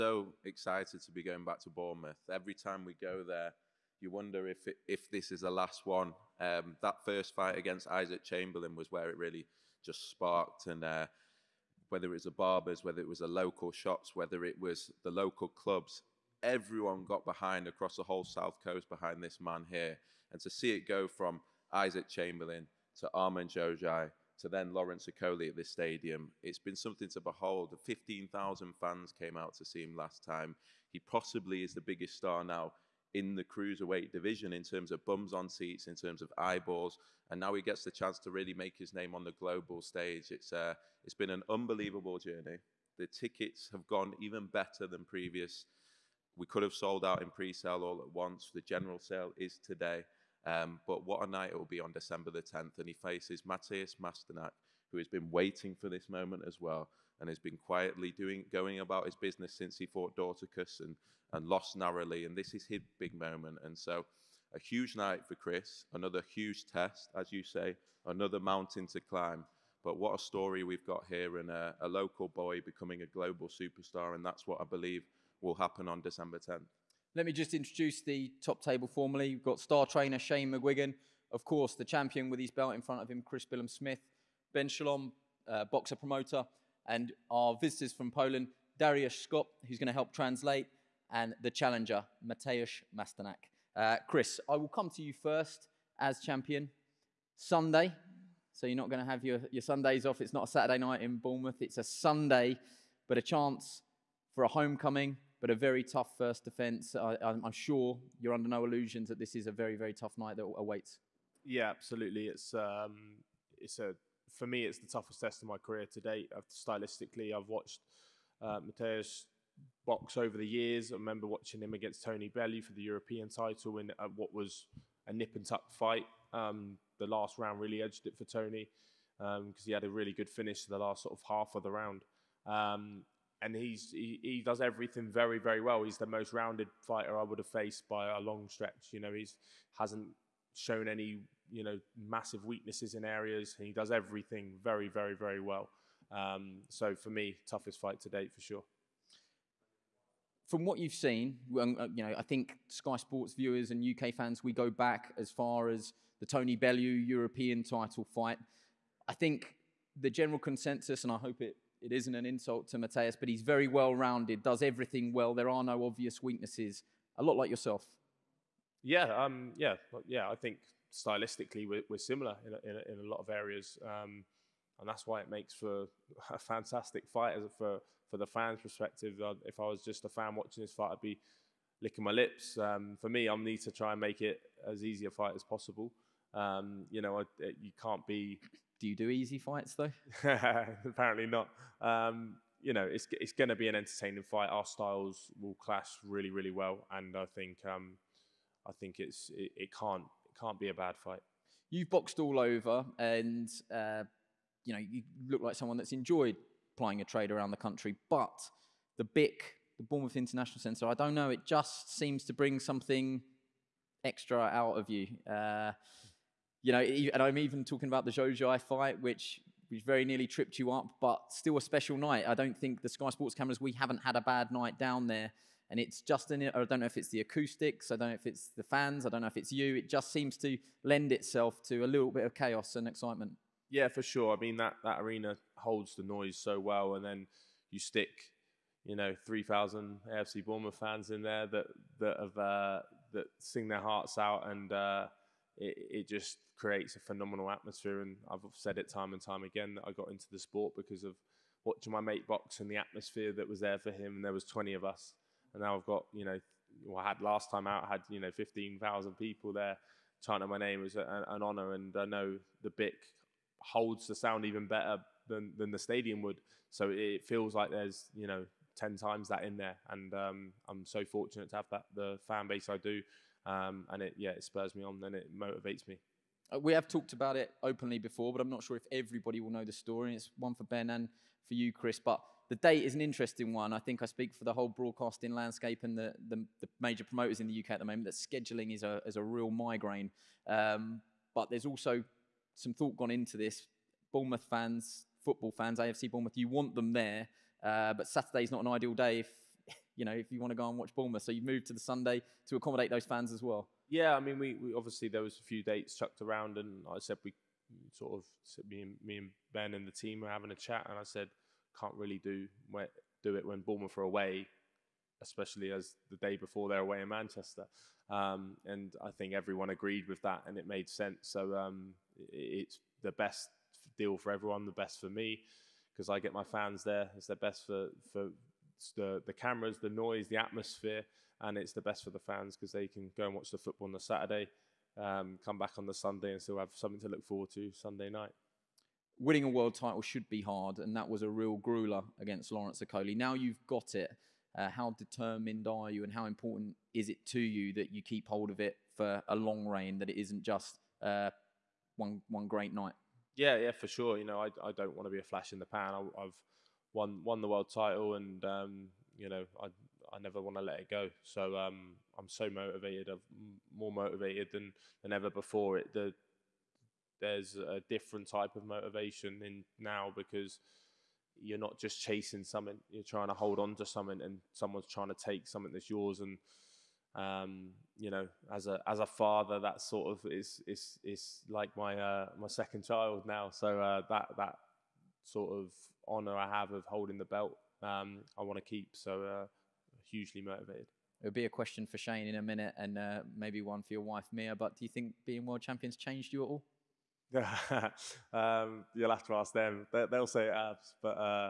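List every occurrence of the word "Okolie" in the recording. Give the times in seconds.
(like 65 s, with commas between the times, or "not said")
25 s, 342 s.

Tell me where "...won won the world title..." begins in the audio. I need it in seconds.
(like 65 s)
356 s.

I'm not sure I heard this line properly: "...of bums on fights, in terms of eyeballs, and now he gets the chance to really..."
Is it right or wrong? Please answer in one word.
wrong.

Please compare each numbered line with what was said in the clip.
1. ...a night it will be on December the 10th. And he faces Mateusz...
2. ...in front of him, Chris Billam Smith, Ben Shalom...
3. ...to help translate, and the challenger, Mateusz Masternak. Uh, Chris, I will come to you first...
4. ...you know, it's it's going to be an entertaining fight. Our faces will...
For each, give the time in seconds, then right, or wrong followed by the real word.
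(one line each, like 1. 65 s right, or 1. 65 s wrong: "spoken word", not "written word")
1. 51 s right
2. 82 s right
3. 89 s right
4. 192 s wrong: "styles", not "faces".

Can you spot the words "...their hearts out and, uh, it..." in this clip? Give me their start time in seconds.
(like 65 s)
243 s.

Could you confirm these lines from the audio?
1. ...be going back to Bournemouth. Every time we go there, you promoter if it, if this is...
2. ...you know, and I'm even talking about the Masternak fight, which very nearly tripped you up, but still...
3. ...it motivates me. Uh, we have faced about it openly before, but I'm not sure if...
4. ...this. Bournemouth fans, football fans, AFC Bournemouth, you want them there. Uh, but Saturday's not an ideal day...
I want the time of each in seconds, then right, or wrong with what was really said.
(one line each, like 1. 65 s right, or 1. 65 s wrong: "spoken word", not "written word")
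1. 1 s wrong: "wonder", not "promoter"
2. 216 s wrong: "Zhou", not "Masternak"
3. 275 s wrong: "talked", not "faced"
4. 293 s right.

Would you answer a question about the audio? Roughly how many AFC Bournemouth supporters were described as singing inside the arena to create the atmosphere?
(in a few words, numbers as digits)
3,000.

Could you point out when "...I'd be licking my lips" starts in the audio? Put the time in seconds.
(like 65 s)
180 s.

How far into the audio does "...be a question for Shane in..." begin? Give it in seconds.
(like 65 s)
391 s.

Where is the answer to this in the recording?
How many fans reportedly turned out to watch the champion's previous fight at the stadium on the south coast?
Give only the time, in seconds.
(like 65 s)
27 s.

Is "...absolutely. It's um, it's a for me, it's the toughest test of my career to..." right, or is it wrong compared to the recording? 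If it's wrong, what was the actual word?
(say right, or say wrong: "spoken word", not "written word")
right.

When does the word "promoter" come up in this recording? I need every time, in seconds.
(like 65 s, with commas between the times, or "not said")
85 s, 287 s.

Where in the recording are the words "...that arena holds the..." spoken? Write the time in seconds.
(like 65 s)
234 s.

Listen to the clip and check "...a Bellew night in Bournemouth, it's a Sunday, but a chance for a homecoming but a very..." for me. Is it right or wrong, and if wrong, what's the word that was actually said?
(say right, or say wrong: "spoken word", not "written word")
wrong: "Saturday", not "Bellew".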